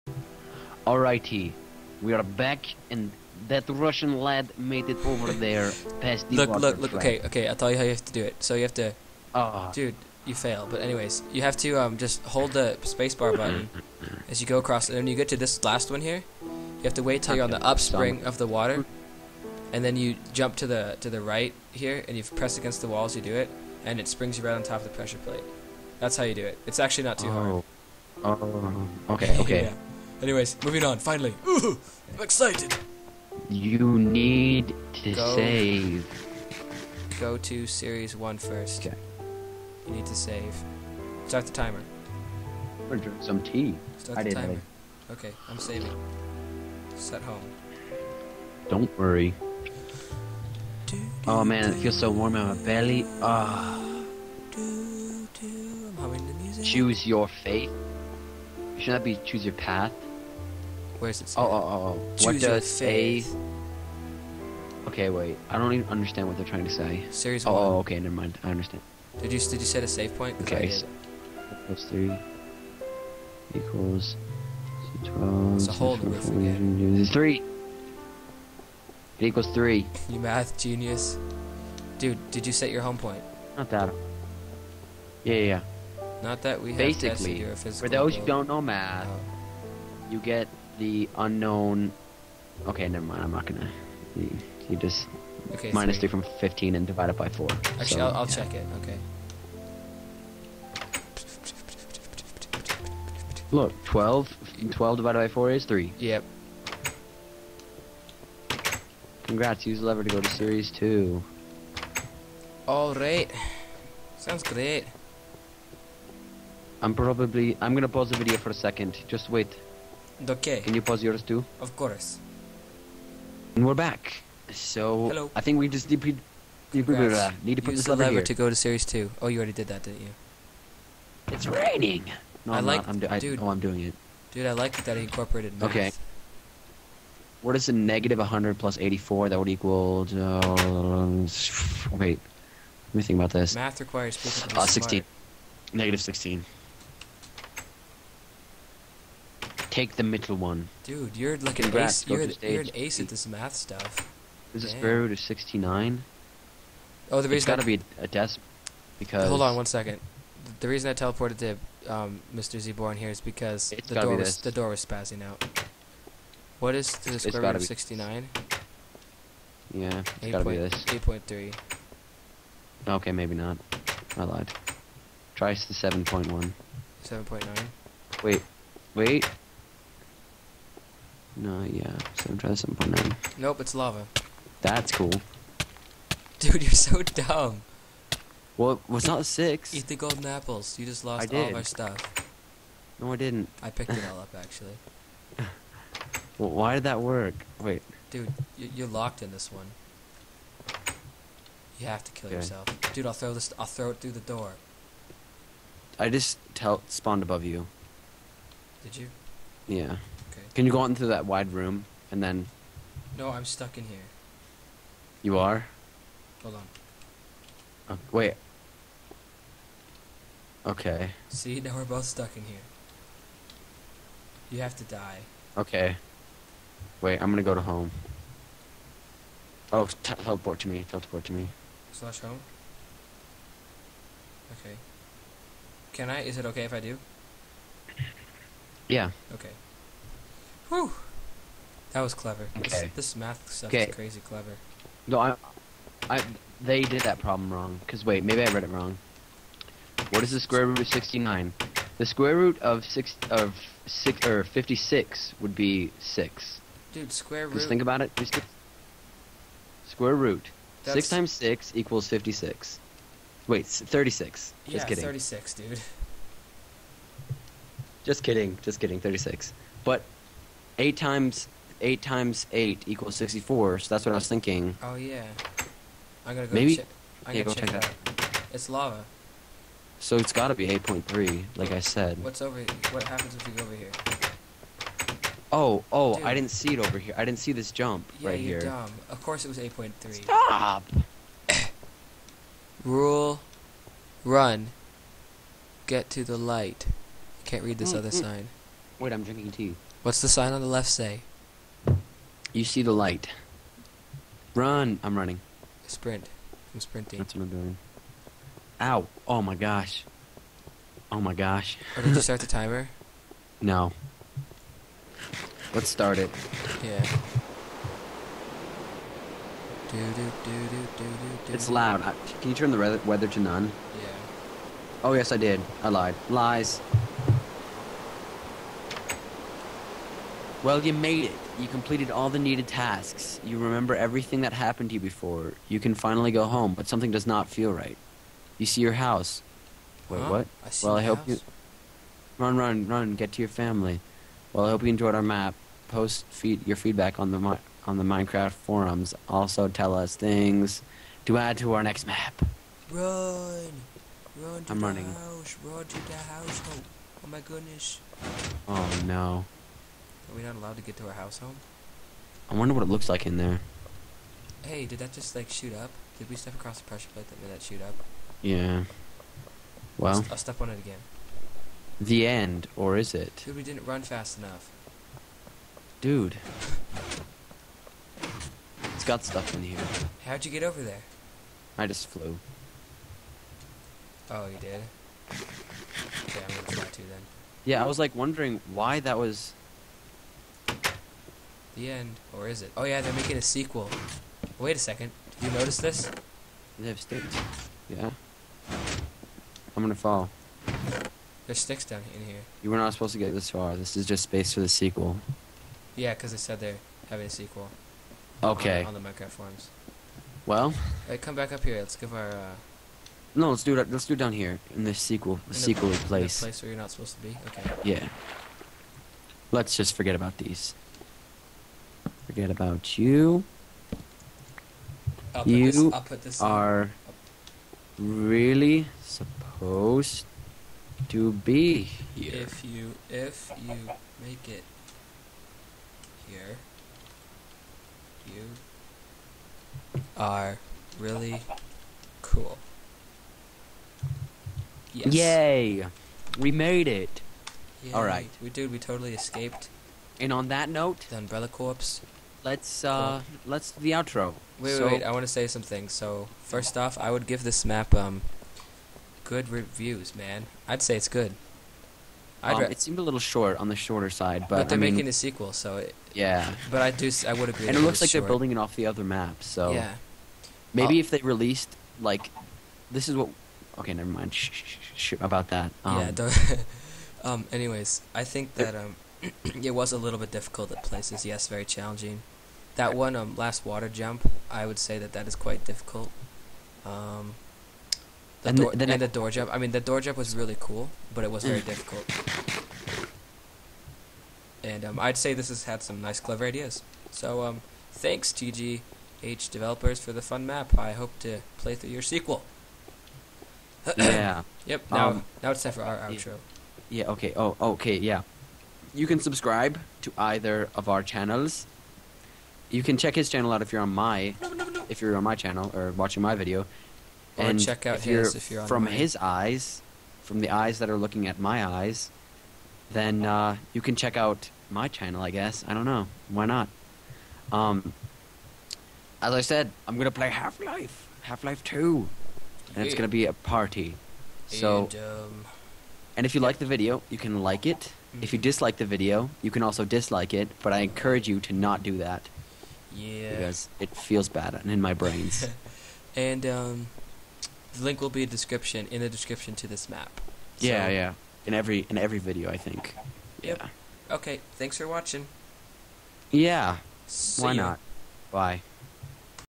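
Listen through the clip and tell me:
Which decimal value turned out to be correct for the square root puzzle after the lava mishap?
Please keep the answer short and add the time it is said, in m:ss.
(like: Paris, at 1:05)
8.3, at 4:39.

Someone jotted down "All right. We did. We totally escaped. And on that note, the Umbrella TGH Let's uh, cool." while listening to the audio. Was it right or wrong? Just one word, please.
wrong.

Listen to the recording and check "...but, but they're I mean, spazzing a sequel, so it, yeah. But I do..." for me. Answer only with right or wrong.
wrong.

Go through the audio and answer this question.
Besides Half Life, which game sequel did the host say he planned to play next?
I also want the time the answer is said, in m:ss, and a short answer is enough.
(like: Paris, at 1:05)
Half Life Two, at 8:51.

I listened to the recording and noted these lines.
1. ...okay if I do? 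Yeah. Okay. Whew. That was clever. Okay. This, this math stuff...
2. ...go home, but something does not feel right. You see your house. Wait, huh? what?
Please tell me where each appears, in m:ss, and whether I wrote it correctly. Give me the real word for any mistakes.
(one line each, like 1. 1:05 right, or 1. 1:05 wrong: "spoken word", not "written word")
1. 3:56 right
2. 5:36 right.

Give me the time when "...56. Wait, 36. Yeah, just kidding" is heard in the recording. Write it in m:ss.
4:22.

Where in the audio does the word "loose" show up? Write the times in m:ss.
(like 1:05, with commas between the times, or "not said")
not said.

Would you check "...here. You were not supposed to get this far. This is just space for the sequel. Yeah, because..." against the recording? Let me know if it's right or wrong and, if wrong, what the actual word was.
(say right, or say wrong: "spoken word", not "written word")
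right.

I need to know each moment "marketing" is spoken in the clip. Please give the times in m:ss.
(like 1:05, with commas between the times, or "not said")
not said.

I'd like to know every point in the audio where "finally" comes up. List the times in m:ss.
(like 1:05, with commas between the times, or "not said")
0:30, 5:35.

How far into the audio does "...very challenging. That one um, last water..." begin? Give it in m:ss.
8:01.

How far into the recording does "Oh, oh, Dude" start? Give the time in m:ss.
4:45.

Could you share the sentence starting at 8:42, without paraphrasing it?
Then uh, you can check out my channel, I guess.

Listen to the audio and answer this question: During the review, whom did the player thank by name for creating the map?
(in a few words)
TGH developers.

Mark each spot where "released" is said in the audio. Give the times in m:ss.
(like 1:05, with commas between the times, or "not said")
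7:51.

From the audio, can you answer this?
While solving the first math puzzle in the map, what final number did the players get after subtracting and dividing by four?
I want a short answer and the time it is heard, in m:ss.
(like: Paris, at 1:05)
3, at 1:44.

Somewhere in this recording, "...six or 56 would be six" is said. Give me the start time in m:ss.
4:13.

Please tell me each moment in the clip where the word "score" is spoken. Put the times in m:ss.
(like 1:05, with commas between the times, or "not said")
not said.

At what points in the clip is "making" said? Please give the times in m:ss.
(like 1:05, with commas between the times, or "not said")
6:33, 7:44.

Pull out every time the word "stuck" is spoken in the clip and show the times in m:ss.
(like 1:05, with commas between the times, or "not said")
3:33, 3:42.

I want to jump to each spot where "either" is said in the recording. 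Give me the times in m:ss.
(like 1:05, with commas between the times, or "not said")
8:30.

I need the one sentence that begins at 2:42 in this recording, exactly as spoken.
ZEeBourne here is because it's the door be was the door was spazzing out.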